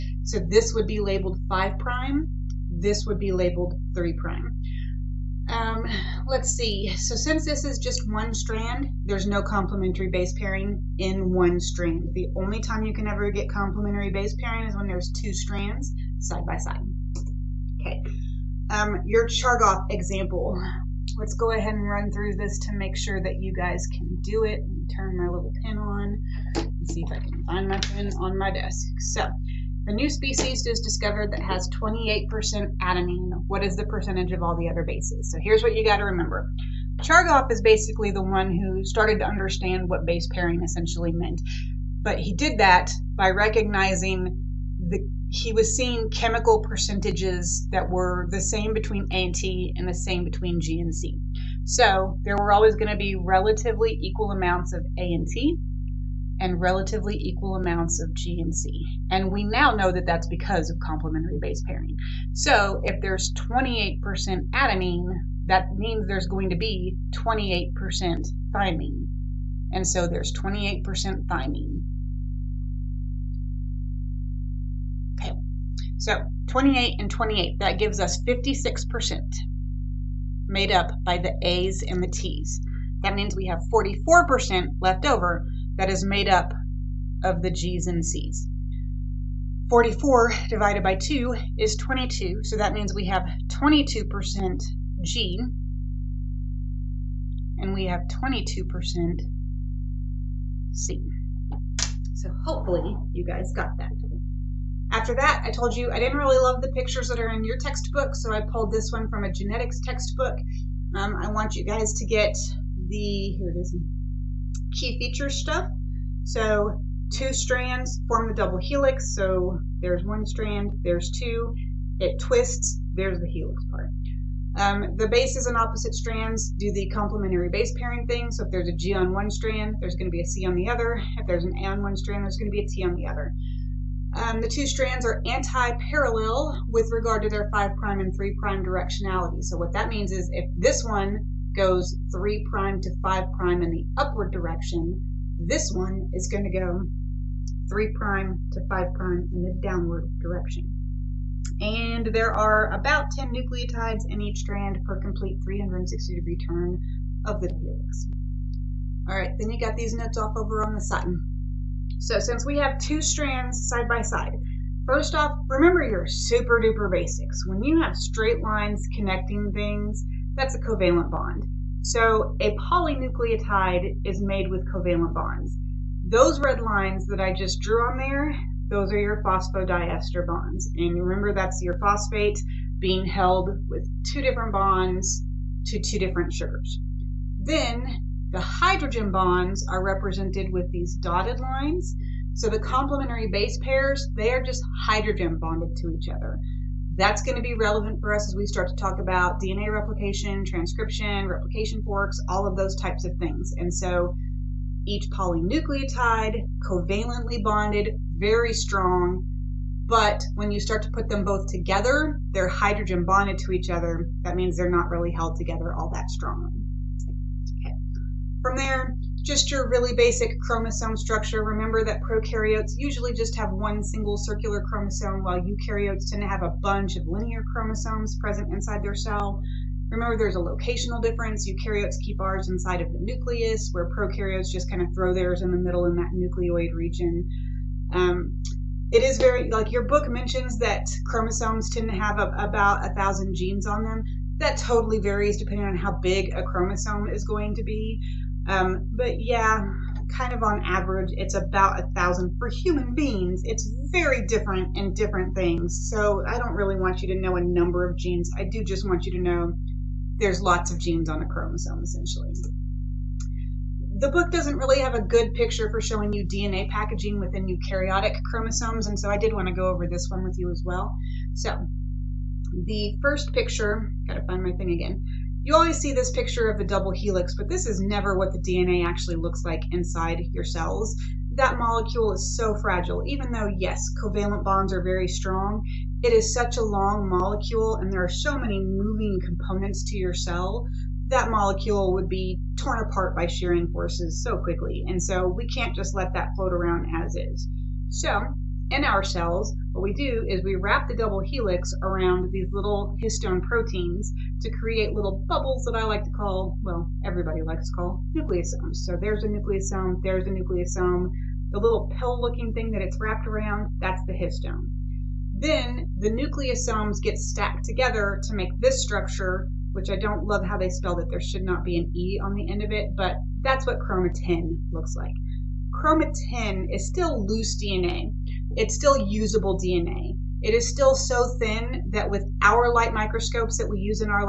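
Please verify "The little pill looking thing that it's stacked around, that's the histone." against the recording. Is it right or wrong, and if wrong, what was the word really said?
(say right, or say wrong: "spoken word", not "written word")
wrong: "wrapped", not "stacked".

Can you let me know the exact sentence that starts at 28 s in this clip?
So the new species is discovered that has 28% adenine.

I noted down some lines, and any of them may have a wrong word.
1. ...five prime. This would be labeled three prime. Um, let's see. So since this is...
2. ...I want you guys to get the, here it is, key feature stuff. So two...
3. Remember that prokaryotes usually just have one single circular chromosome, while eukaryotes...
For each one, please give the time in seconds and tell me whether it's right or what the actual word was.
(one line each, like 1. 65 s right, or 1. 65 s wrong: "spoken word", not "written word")
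1. 1 s right
2. 111 s right
3. 221 s right.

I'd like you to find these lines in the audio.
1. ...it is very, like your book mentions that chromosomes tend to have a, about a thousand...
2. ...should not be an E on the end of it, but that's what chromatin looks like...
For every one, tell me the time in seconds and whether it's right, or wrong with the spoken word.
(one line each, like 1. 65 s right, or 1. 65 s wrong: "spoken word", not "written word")
1. 238 s right
2. 321 s right.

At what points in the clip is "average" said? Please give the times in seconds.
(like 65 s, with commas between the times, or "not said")
250 s.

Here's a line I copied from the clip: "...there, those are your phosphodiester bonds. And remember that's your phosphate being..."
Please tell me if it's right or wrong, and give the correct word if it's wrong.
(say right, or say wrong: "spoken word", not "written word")
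right.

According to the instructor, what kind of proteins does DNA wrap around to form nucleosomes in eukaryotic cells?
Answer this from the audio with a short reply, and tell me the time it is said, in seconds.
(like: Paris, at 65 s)
histone proteins, at 303 s.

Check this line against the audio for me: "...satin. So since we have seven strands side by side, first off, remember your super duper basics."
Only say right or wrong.
wrong.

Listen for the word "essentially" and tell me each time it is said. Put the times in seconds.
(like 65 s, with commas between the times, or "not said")
40 s, 261 s.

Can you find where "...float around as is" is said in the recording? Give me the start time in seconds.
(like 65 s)
296 s.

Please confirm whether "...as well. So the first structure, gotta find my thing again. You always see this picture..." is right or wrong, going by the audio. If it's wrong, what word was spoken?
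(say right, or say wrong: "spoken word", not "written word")
wrong: "picture", not "structure".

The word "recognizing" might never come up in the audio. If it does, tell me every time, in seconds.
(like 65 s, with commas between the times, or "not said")
43 s.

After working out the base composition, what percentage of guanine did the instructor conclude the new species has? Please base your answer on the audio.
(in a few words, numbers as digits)
22%.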